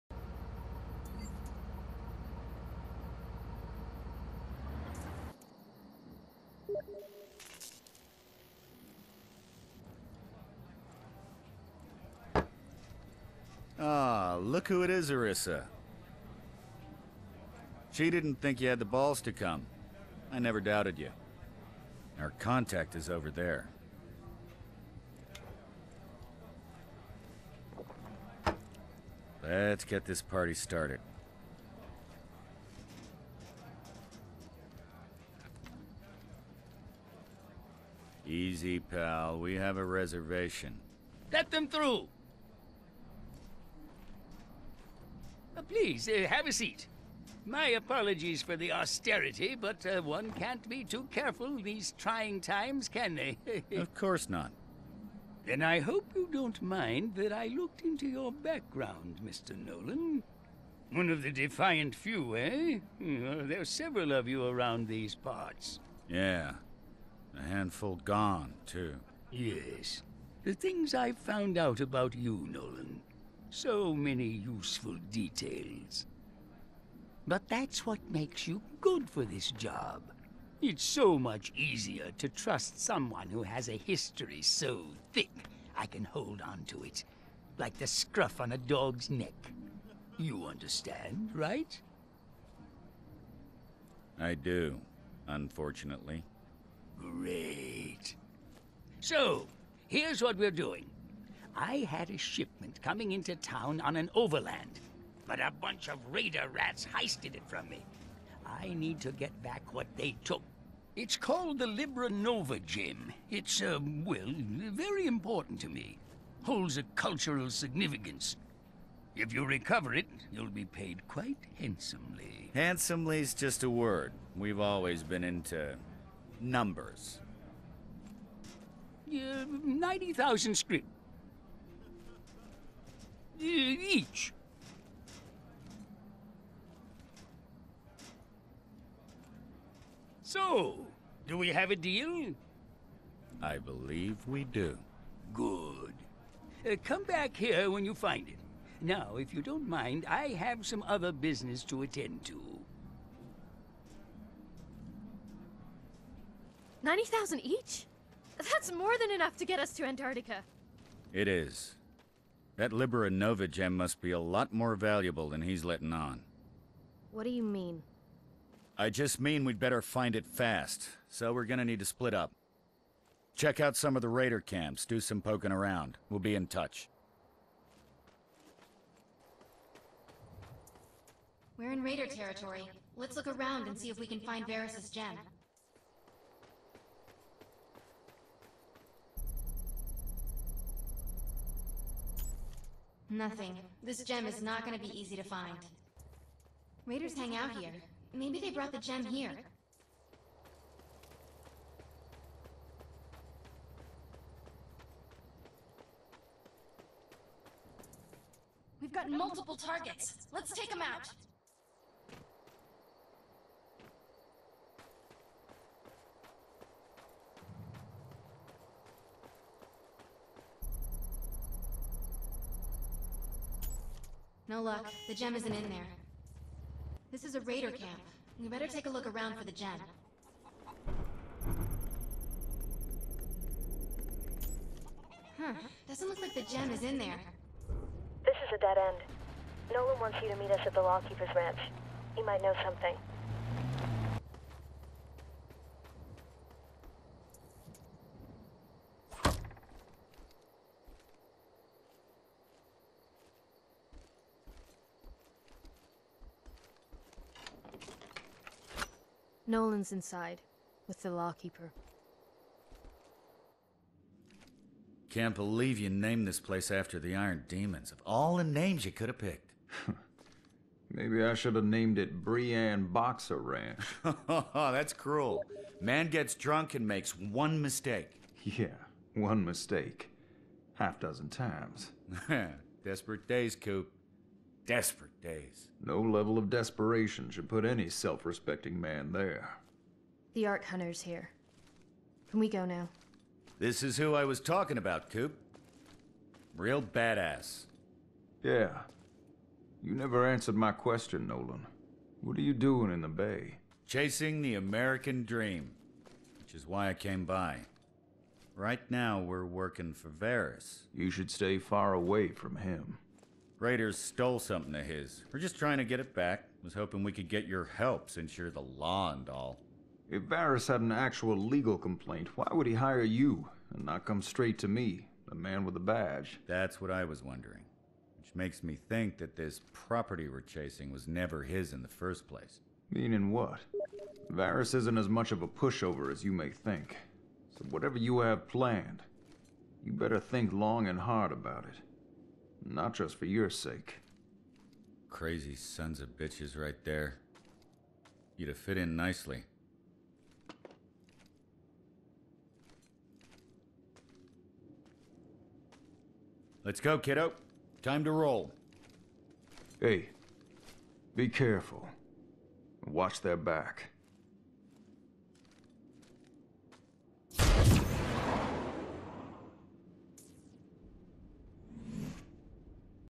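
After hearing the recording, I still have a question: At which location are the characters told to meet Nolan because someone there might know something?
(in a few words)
Lawkeeper's Ranch.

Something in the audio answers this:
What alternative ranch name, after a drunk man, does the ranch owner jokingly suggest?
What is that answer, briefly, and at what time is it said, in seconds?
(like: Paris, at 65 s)
Brienne Boxer Ranch, at 272 s.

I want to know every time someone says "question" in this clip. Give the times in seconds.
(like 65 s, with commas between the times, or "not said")
300 s.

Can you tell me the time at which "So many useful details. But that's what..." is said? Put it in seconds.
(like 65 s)
73 s.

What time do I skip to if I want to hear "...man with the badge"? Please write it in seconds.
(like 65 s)
325 s.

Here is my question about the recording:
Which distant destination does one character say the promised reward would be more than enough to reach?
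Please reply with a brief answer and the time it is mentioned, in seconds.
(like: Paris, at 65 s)
Antarctica, at 159 s.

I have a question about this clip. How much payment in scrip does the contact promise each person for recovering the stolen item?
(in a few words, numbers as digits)
90,000.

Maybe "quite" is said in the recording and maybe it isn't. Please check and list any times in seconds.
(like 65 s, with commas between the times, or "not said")
121 s.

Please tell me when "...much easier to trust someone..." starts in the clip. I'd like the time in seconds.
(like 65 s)
81 s.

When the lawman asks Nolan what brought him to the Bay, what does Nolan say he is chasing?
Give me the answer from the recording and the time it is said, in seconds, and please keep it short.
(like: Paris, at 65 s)
the American dream, at 304 s.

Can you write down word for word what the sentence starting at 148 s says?
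Now, if you don't mind, I have some other business to attend to.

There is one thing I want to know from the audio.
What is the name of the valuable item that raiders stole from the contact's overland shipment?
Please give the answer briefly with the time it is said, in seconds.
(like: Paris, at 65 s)
Libra Nova gem, at 111 s.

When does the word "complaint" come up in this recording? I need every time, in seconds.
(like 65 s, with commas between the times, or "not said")
321 s.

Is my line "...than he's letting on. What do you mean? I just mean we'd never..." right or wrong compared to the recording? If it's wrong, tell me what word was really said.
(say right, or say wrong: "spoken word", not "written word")
wrong: "better", not "never".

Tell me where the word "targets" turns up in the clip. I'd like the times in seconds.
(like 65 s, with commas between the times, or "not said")
209 s.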